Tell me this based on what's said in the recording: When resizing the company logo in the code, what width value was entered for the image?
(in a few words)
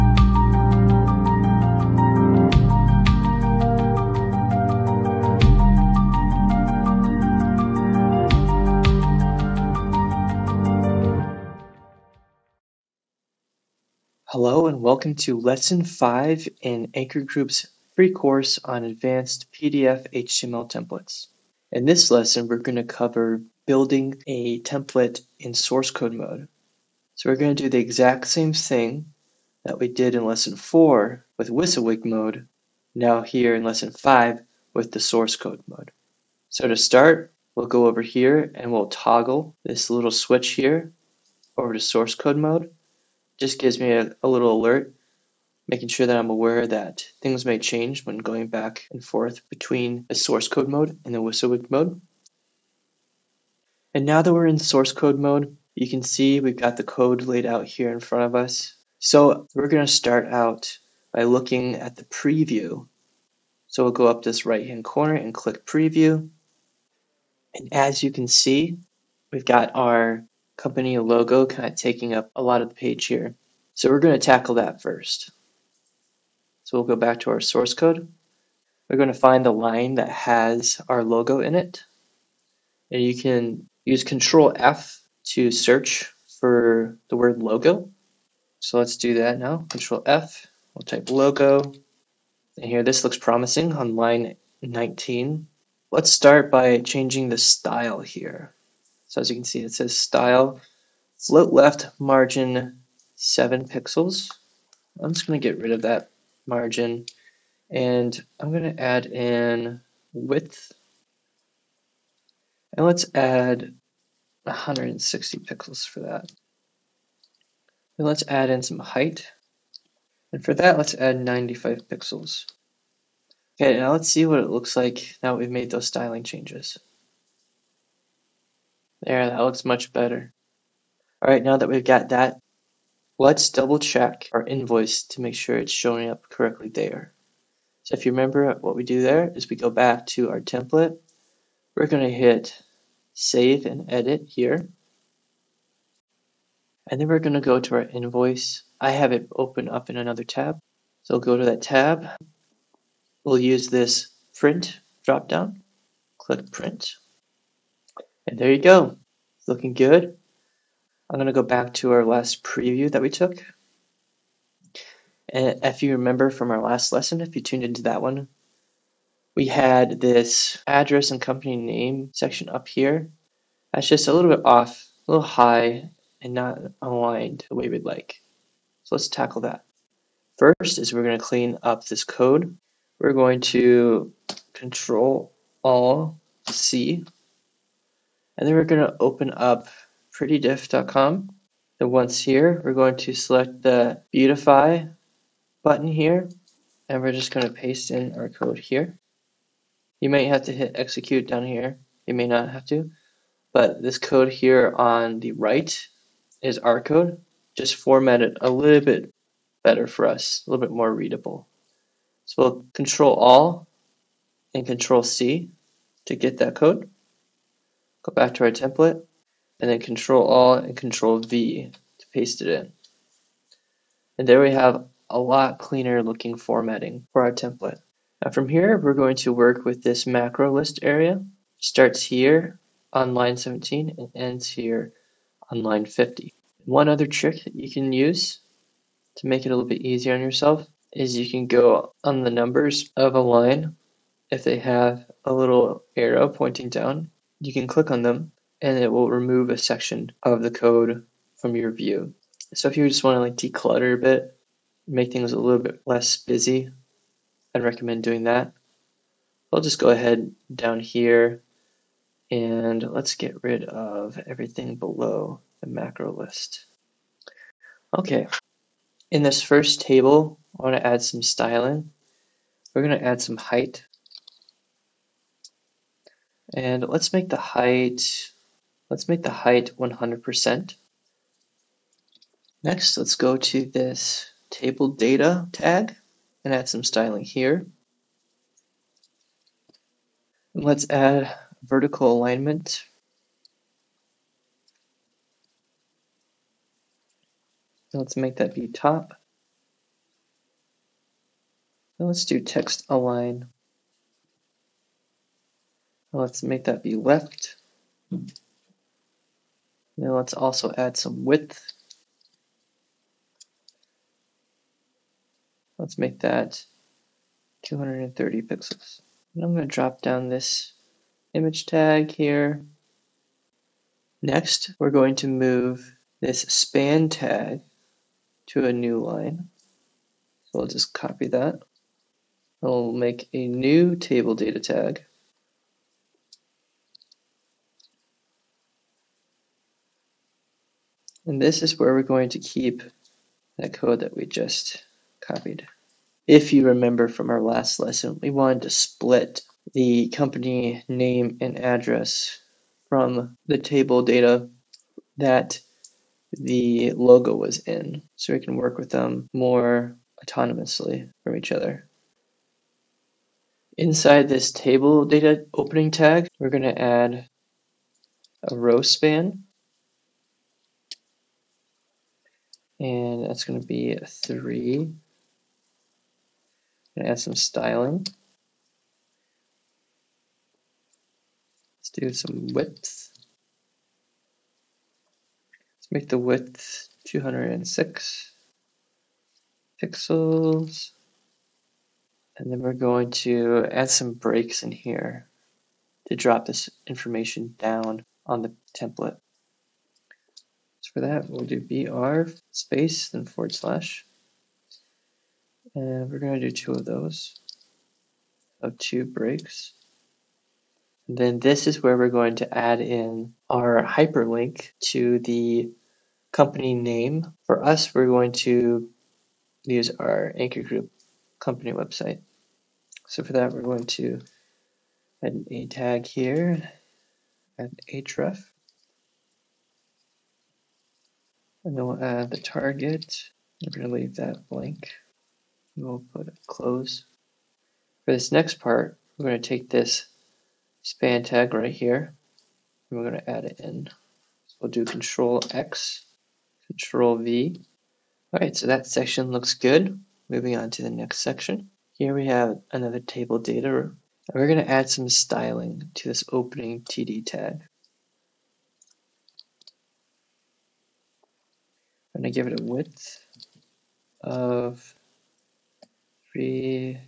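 160 pixels.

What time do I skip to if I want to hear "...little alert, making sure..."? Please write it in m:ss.
0:44.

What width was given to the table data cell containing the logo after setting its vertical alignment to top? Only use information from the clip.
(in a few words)
230 pixels.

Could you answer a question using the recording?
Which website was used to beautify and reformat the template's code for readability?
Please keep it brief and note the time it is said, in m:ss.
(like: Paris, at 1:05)
prettydiff.com, at 3:10.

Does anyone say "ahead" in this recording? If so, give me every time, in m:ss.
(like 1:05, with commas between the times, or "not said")
4:19.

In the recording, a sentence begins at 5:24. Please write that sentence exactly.
Next, we're going to move this span tag to a new line.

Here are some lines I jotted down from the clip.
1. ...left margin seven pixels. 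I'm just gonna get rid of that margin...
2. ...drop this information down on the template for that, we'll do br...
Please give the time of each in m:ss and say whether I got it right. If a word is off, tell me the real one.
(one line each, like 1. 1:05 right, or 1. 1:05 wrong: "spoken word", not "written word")
1. 1:41 right
2. 6:36 right.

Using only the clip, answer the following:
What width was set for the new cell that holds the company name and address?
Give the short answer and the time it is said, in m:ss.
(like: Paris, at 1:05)
206 pixels, at 6:27.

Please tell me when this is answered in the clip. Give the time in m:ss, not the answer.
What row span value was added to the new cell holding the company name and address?
6:14.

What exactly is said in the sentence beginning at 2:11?
All right, now that we've got that, let's double check our invoice to make sure it's showing up correctly there.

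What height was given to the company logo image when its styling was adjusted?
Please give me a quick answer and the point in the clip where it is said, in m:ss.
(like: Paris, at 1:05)
95 pixels, at 2:01.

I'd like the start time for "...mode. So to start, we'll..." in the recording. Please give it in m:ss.
0:35.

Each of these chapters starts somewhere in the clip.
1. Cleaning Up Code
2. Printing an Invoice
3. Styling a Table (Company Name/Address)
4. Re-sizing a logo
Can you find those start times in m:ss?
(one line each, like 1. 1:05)
1. 2:59
2. 2:10
3. 4:28
4. 1:16.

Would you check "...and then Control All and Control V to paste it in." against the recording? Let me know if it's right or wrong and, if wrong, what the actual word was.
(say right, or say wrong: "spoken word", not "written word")
right.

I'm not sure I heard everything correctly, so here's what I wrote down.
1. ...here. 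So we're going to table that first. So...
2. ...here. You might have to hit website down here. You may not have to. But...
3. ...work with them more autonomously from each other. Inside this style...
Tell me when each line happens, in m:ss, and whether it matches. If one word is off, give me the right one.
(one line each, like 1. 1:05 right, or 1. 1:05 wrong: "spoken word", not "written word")
1. 1:13 wrong: "tackle", not "table"
2. 3:18 wrong: "execute", not "website"
3. 5:58 wrong: "table", not "style".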